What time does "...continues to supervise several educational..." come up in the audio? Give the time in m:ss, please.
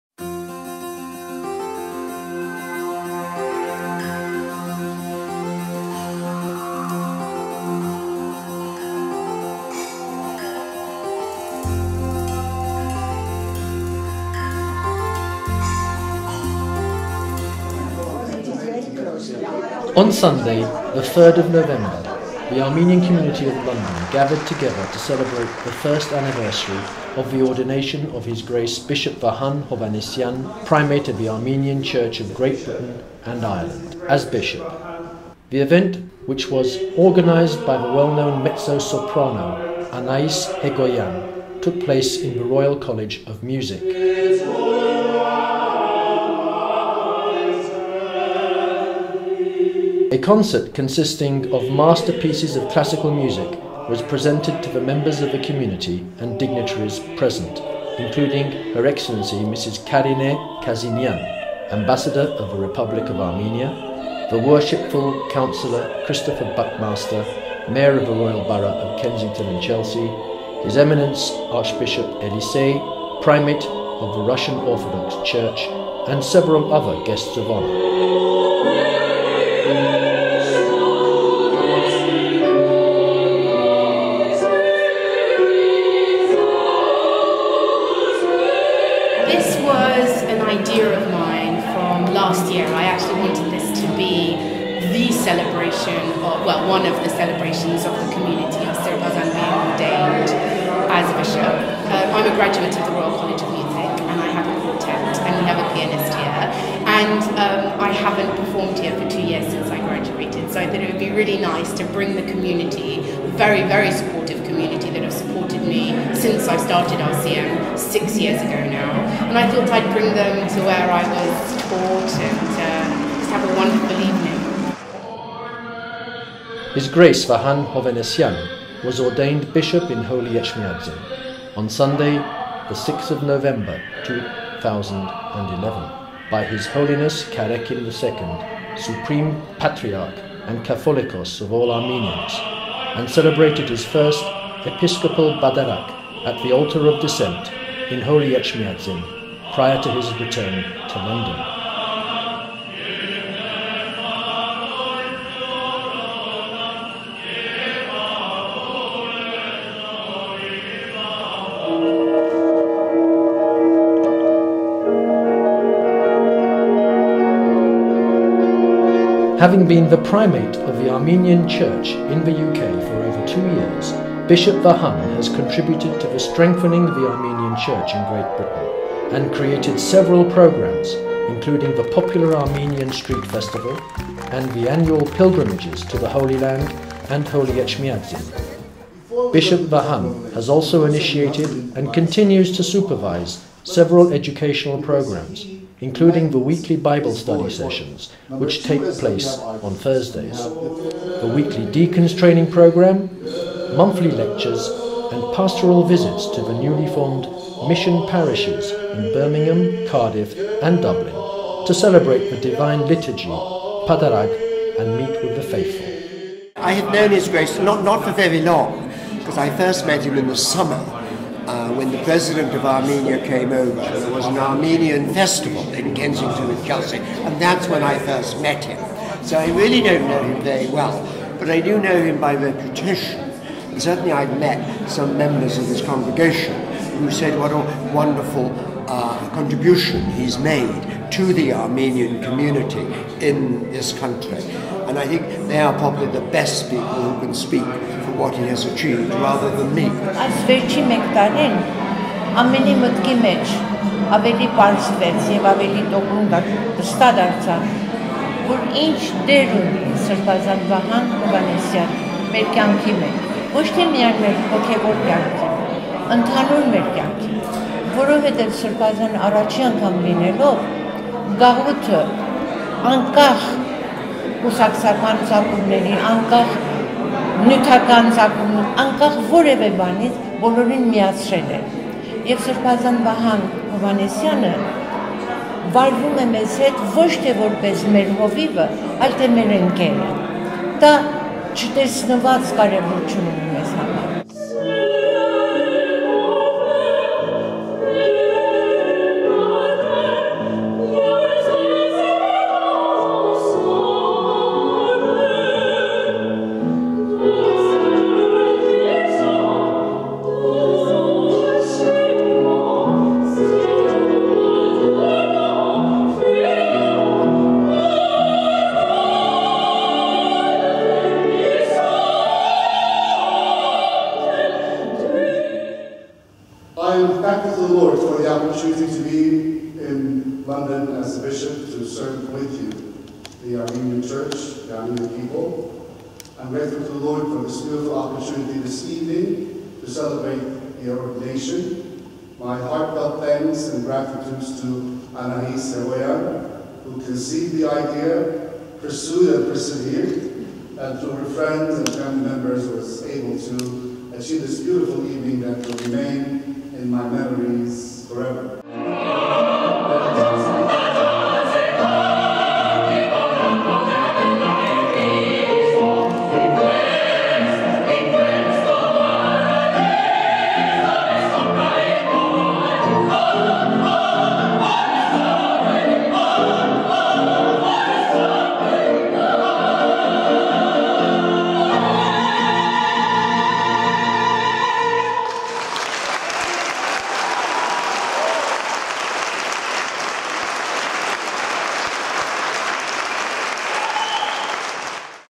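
3:11.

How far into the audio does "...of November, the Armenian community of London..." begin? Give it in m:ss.
0:21.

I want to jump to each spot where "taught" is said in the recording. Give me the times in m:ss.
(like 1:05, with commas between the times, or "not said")
2:01.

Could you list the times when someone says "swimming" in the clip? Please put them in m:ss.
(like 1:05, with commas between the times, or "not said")
not said.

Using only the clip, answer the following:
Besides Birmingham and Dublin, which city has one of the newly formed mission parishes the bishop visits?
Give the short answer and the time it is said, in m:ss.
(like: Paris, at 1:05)
Cardiff, at 3:29.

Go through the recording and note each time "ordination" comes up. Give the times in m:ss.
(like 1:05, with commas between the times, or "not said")
0:27, 5:40.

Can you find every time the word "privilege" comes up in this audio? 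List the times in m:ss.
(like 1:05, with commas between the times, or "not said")
not said.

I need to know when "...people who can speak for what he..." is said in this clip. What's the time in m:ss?
4:06.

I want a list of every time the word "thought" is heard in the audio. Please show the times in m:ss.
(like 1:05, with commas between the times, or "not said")
1:50, 1:59.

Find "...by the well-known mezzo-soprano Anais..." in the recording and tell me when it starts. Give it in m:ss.
0:37.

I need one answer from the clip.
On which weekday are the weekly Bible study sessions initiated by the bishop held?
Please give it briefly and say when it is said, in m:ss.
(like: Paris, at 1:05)
Thursdays, at 3:19.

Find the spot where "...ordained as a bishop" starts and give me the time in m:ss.
1:39.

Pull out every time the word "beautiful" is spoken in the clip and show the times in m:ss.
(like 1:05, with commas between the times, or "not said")
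5:37, 5:54.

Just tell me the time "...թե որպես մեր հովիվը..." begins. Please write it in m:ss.
4:47.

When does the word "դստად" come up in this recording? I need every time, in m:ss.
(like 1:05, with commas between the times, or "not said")
4:16.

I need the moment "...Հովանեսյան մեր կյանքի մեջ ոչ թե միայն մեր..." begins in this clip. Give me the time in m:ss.
4:21.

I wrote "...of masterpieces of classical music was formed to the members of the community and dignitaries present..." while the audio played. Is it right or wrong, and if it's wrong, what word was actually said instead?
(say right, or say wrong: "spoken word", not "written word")
wrong: "presented", not "formed".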